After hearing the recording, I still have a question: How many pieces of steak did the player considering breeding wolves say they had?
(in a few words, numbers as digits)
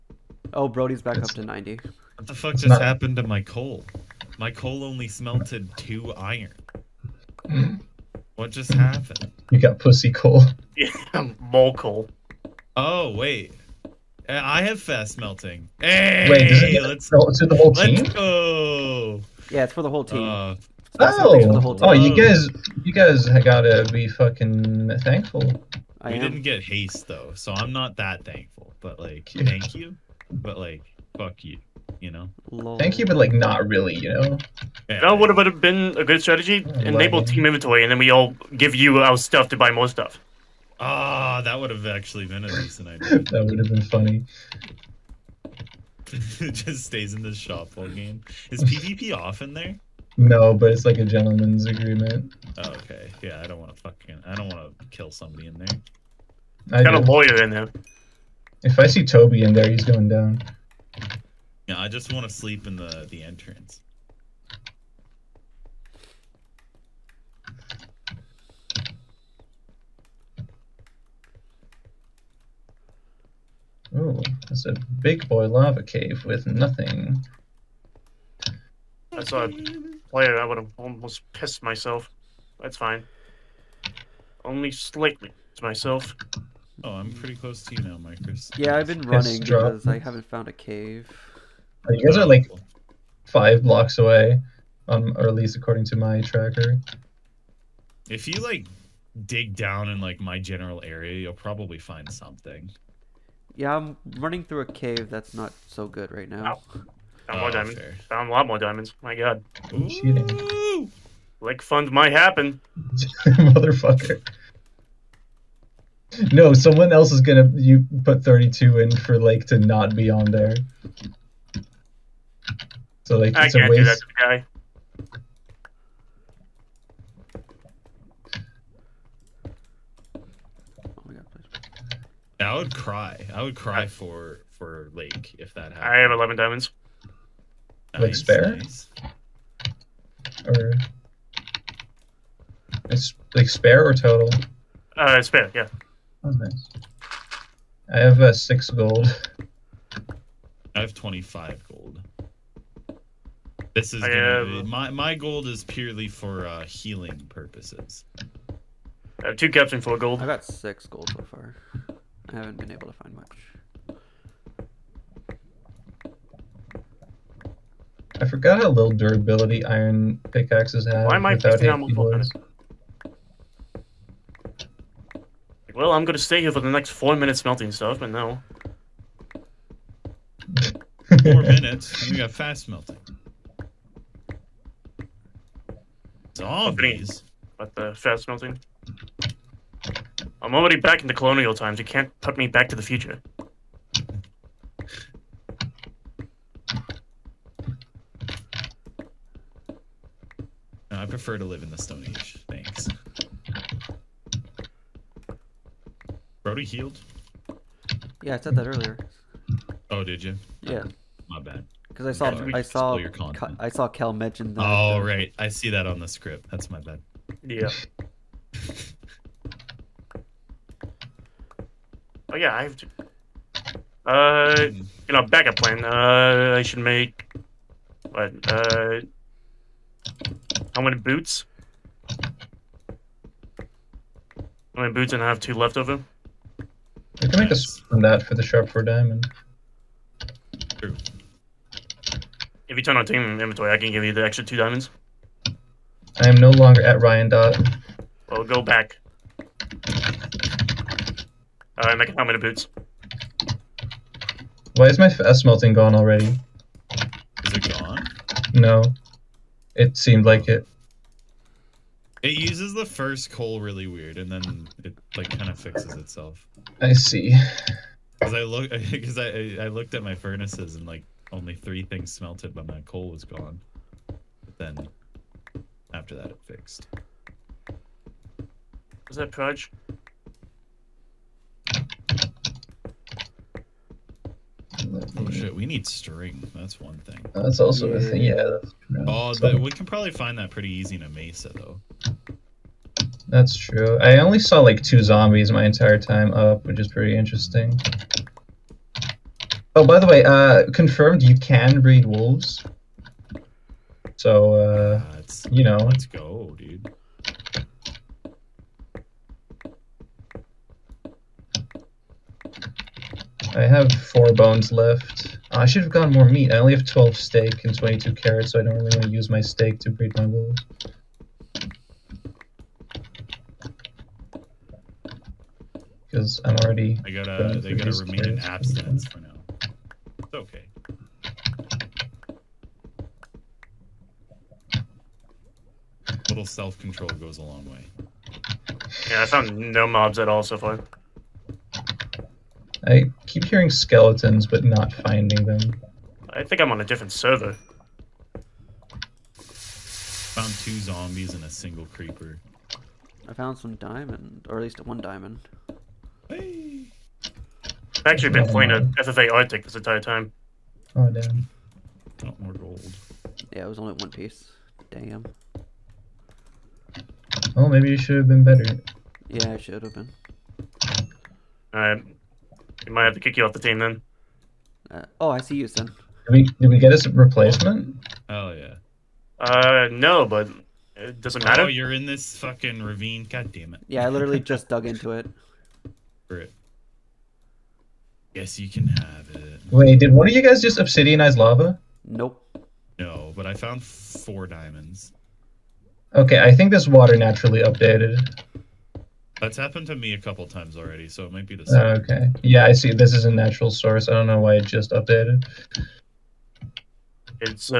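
12.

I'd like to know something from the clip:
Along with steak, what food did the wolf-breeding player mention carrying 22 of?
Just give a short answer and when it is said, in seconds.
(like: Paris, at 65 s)
Carrots, at 317 s.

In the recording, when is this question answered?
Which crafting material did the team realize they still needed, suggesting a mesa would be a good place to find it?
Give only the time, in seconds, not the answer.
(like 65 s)
285 s.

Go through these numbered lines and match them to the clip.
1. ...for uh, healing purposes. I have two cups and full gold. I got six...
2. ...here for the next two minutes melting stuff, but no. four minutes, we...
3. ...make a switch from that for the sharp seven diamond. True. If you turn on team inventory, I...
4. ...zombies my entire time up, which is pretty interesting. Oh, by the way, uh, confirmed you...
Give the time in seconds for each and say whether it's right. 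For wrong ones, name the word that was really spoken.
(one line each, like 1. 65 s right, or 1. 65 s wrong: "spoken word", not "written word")
1. 156 s right
2. 176 s wrong: "four", not "two"
3. 237 s wrong: "four", not "seven"
4. 295 s right.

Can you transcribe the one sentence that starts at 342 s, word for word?
I keep hearing skeletons, but not finding them.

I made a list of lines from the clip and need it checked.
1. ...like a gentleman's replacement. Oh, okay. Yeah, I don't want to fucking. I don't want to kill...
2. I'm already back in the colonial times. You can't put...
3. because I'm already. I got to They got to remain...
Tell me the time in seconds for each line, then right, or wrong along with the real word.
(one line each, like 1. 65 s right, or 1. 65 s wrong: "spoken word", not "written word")
1. 50 s wrong: "agreement", not "replacement"
2. 190 s right
3. 326 s right.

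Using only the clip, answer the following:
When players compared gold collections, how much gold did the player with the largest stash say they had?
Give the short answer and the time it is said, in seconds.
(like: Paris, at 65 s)
25, at 150 s.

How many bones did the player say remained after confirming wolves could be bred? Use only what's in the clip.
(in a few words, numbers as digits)
4.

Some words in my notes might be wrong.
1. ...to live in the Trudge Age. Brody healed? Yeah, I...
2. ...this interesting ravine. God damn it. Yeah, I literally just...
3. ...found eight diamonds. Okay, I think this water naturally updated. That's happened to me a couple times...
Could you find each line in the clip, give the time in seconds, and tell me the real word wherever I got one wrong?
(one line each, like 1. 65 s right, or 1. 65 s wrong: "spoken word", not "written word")
1. 201 s wrong: "Stone", not "Trudge"
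2. 382 s wrong: "fucking", not "interesting"
3. 393 s wrong: "four", not "eight".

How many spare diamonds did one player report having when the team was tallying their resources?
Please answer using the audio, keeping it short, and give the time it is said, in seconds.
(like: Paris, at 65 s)
11, at 135 s.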